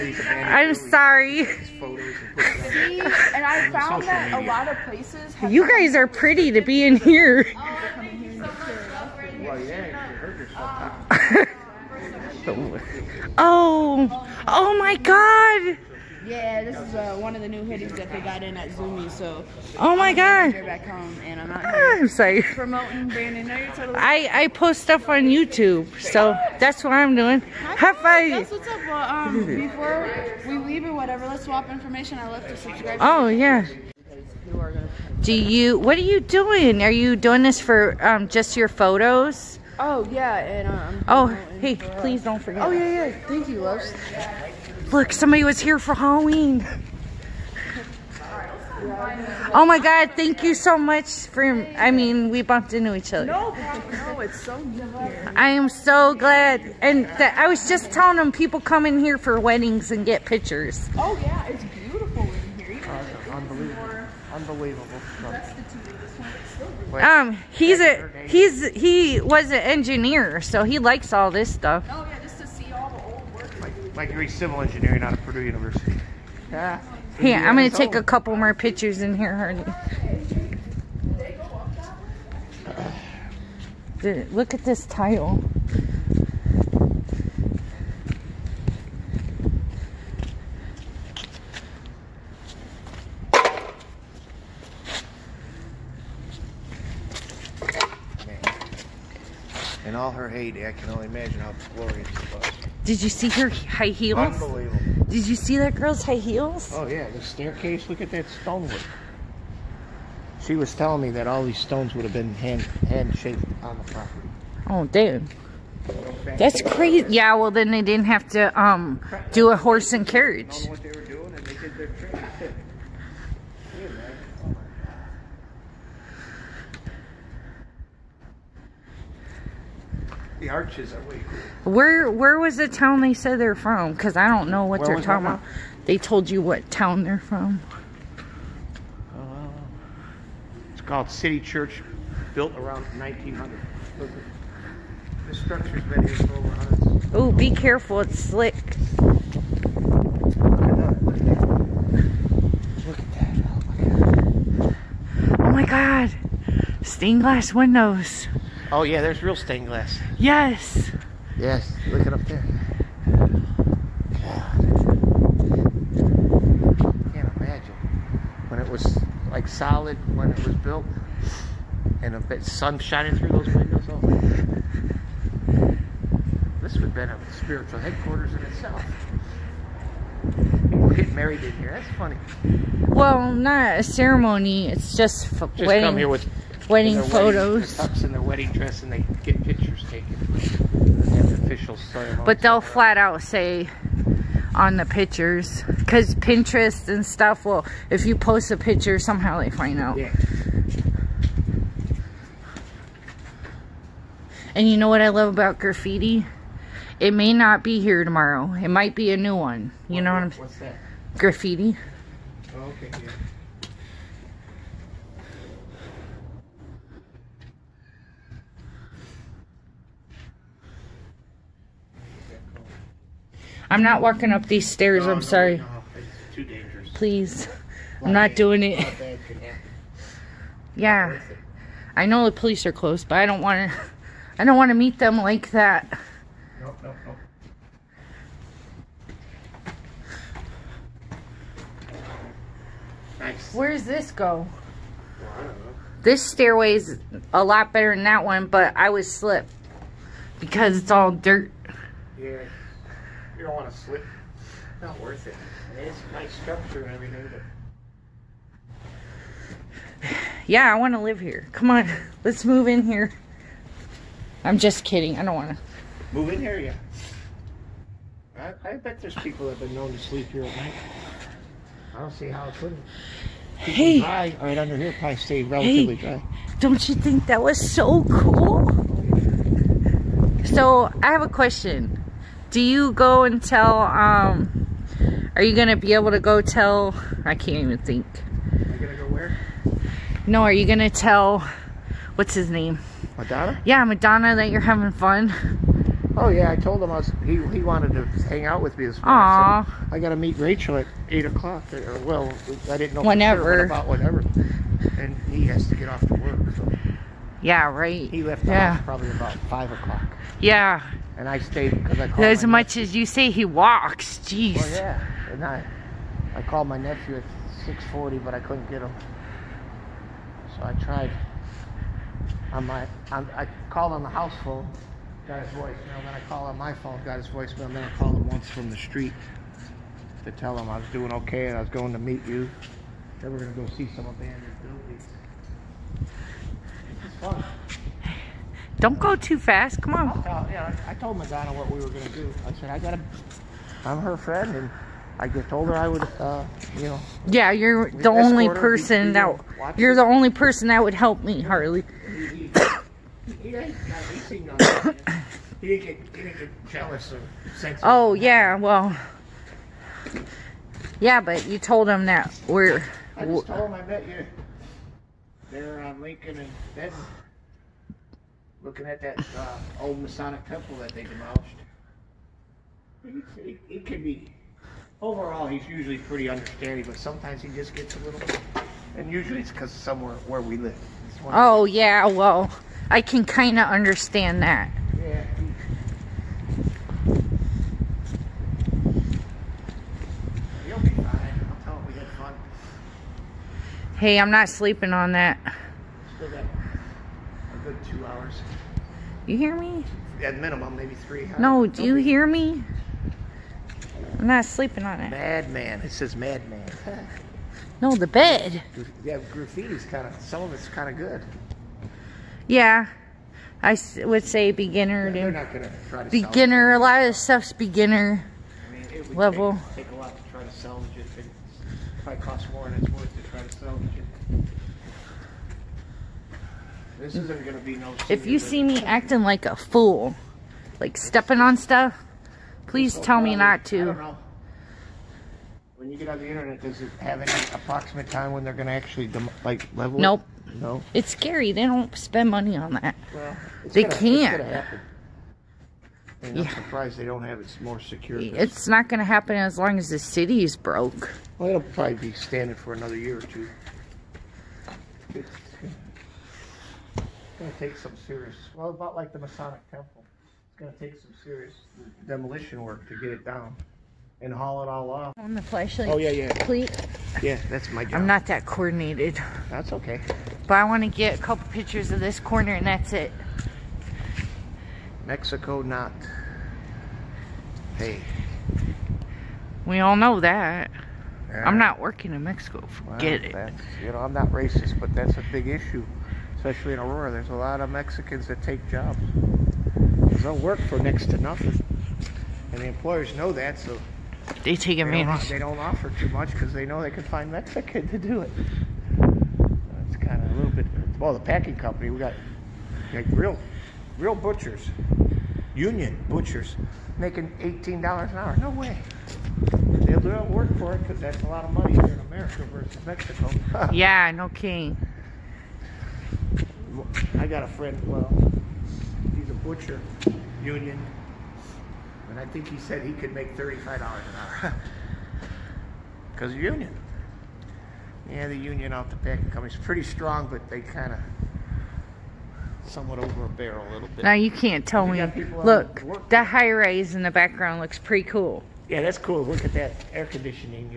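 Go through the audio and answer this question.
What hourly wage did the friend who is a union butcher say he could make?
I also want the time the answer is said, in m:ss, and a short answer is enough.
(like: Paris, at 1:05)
$35, at 8:43.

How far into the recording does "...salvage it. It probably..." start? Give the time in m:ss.
7:00.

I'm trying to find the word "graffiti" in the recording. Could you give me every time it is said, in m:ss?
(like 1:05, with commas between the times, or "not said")
3:25, 3:31, 6:49.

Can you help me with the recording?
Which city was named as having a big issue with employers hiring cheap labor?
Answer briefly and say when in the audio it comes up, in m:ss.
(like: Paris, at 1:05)
Aurora, at 8:06.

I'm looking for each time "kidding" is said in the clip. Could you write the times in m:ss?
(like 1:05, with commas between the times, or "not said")
4:24, 8:34.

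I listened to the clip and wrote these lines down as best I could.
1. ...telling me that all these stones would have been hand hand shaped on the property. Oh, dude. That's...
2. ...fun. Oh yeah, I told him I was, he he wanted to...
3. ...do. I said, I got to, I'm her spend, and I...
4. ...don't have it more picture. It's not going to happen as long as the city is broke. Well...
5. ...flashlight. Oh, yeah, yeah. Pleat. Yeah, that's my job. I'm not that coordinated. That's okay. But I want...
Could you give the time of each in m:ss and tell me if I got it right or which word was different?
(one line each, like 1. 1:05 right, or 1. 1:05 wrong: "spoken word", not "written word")
1. 1:50 right
2. 4:54 right
3. 5:42 wrong: "friend", not "spend"
4. 7:27 wrong: "secure", not "picture"
5. 7:45 right.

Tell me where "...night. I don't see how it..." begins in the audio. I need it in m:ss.
4:30.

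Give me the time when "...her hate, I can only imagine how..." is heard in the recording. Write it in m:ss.
1:40.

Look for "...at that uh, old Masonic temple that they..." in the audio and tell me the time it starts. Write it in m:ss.
6:08.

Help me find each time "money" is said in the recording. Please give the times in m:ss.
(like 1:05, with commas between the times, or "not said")
7:22, 8:31.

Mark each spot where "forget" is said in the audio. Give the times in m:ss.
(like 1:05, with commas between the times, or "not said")
0:42, 8:02.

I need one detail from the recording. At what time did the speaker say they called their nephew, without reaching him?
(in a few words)
6:40.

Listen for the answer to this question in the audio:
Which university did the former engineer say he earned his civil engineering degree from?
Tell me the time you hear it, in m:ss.
1:15.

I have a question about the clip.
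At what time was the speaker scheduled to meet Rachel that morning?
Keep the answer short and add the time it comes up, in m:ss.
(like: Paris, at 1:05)
8 o'clock, at 5:01.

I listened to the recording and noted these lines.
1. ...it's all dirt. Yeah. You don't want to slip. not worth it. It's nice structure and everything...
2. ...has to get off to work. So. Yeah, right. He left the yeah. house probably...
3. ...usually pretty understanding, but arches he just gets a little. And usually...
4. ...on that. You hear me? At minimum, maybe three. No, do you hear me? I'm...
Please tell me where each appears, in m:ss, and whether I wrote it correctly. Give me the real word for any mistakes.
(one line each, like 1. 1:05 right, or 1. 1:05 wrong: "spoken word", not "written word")
1. 4:10 right
2. 5:05 right
3. 6:15 wrong: "sometimes", not "arches"
4. 6:34 right.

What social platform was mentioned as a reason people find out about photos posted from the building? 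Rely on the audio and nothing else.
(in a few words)
Pinterest.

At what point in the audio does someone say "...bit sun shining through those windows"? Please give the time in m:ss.
2:52.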